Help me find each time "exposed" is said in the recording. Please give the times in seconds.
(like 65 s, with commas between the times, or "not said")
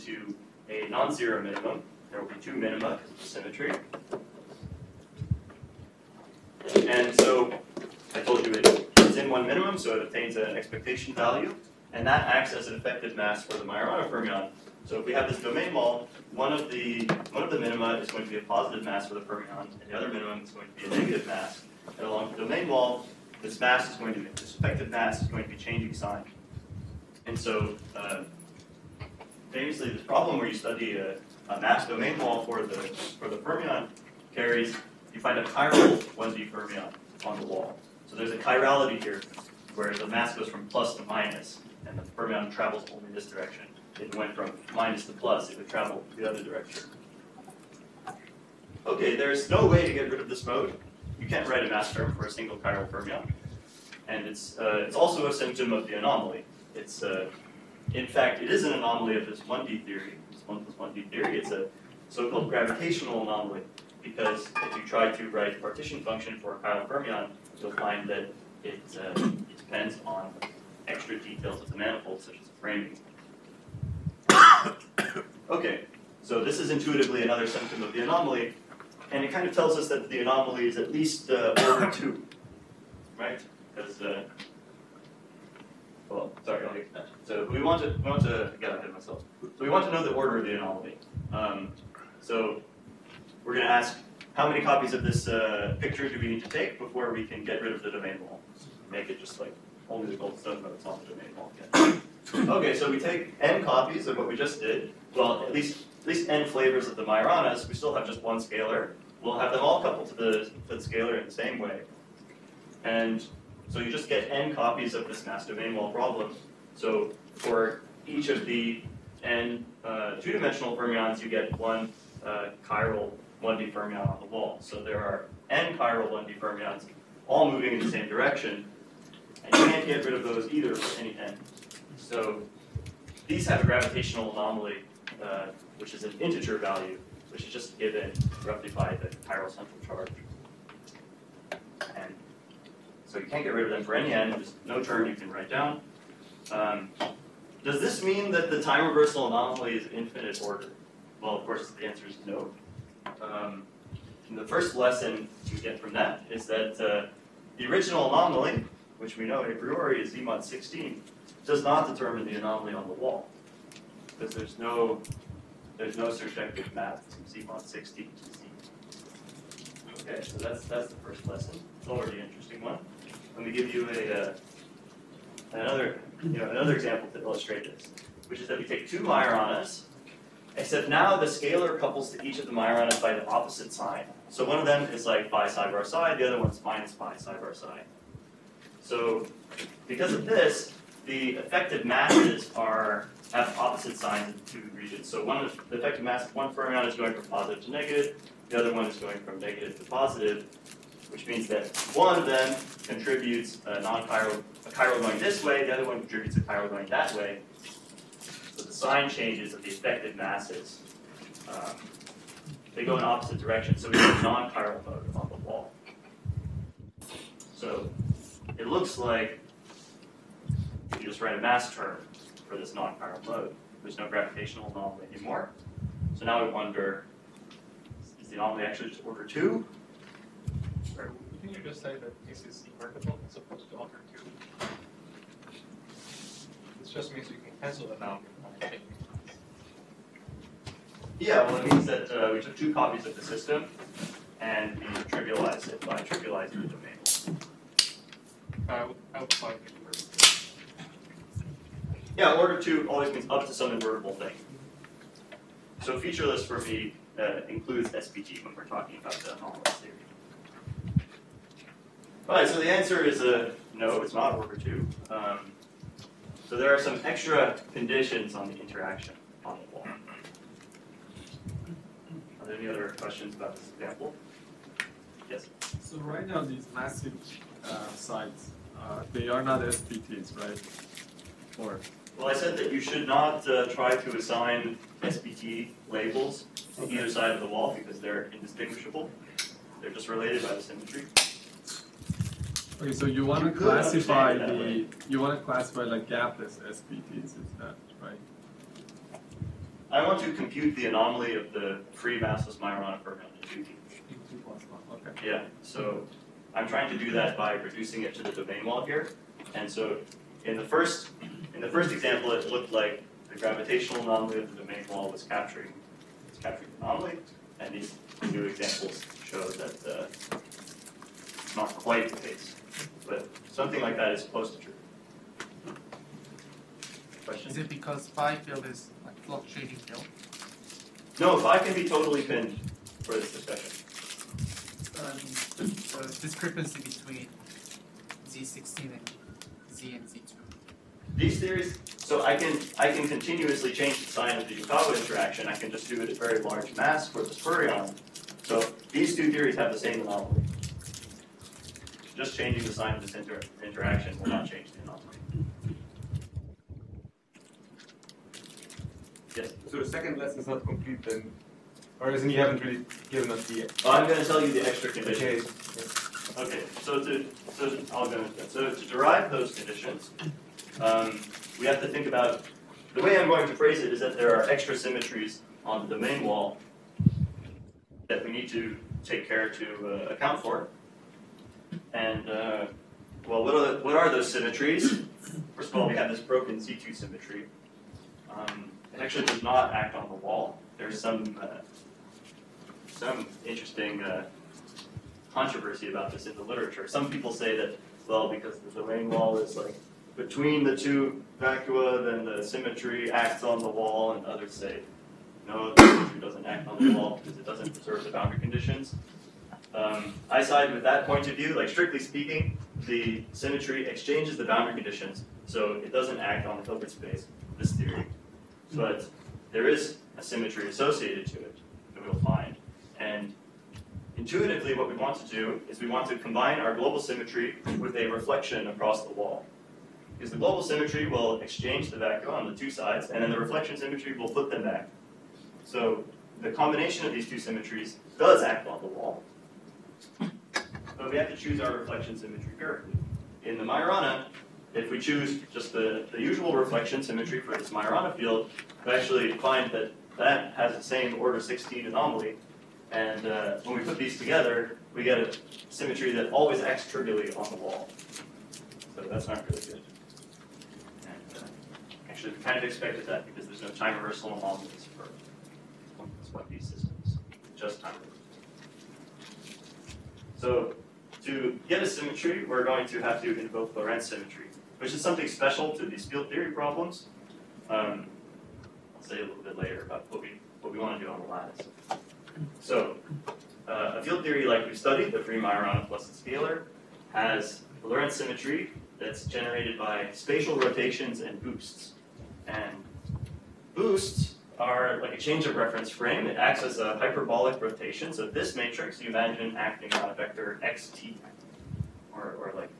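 not said.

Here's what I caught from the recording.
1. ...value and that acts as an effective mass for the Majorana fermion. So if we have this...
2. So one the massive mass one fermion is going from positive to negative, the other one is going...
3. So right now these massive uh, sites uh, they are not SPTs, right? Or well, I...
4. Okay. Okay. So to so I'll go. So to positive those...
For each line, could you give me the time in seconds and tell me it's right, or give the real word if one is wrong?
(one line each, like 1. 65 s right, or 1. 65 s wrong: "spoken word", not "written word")
1. 11 s right
2. 195 s wrong: "effective", not "massive"
3. 275 s right
4. 366 s wrong: "derive", not "positive".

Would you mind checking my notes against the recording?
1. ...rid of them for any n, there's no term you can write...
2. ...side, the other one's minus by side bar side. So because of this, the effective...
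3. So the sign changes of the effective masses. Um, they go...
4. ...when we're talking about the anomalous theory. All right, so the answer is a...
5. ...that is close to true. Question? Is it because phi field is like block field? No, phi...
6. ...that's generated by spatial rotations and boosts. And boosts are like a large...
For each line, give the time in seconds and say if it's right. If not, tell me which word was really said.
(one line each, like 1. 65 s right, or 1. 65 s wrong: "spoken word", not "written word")
1. 143 s right
2. 185 s right
3. 208 s right
4. 258 s right
5. 323 s right
6. 488 s wrong: "change", not "large".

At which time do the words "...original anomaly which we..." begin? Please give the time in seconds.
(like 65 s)
157 s.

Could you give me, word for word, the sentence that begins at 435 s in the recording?
So the combination of these two symmetries does act on the wall.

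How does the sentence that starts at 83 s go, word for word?
Because, uh, well, sorry, I'll get that.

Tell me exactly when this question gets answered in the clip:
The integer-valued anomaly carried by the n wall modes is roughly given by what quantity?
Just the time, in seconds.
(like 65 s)
139 s.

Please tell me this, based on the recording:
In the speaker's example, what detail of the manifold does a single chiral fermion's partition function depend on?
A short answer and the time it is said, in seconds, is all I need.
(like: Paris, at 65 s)
framing, at 72 s.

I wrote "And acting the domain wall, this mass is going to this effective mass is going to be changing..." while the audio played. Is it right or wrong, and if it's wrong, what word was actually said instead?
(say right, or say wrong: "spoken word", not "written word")
wrong: "along", not "acting".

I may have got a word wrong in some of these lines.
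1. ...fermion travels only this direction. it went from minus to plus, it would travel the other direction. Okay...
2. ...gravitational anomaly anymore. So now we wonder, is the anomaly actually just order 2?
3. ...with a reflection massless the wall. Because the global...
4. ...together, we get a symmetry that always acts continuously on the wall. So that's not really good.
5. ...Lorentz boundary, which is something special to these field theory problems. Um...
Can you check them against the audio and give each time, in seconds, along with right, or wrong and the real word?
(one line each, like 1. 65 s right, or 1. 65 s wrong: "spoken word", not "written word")
1. 42 s right
2. 224 s right
3. 427 s wrong: "across", not "massless"
4. 454 s wrong: "trivially", not "continuously"
5. 473 s wrong: "symmetry", not "boundary".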